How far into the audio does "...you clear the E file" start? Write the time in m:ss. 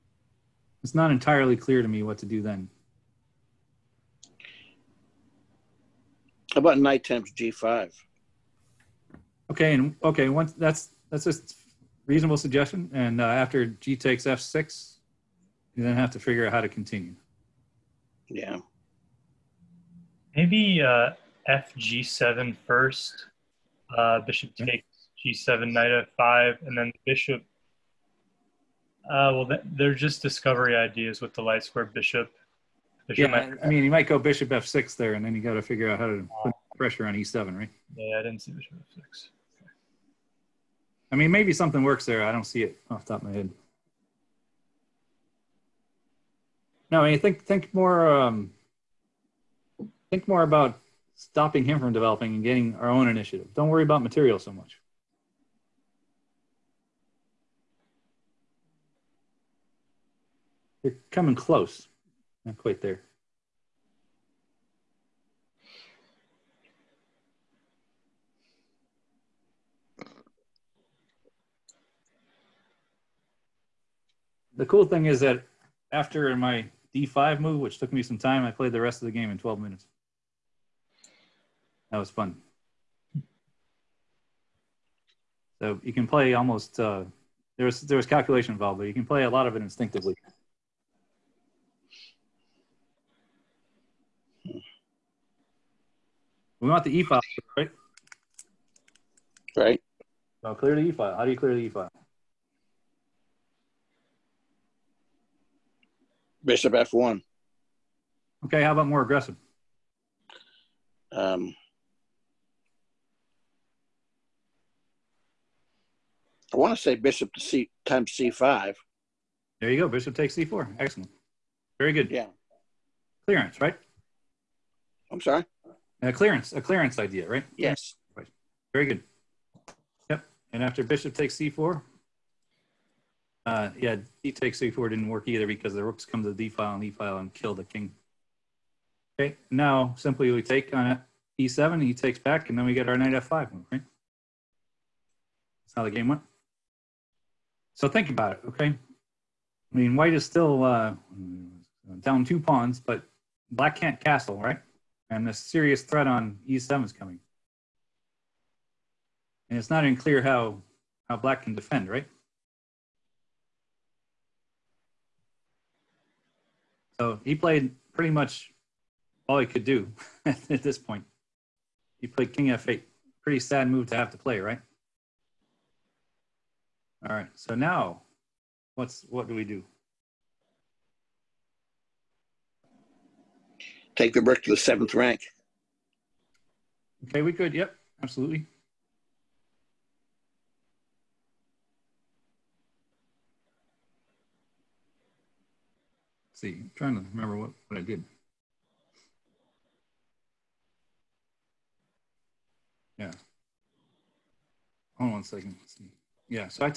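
1:41.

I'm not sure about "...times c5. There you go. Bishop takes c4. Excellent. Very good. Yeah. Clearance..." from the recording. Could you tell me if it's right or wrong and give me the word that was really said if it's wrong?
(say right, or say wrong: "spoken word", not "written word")
right.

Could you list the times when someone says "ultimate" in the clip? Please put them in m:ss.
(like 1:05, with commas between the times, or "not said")
not said.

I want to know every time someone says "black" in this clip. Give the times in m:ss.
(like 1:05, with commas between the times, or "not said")
2:33, 2:41.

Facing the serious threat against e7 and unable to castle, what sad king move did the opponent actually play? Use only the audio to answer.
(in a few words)
King f8.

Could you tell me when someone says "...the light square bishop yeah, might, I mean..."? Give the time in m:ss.
0:31.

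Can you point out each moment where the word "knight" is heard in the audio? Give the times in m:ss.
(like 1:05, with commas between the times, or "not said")
0:06, 0:25, 2:22.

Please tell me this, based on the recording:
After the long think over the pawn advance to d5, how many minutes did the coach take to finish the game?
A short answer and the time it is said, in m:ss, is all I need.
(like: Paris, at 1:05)
12 minutes, at 1:19.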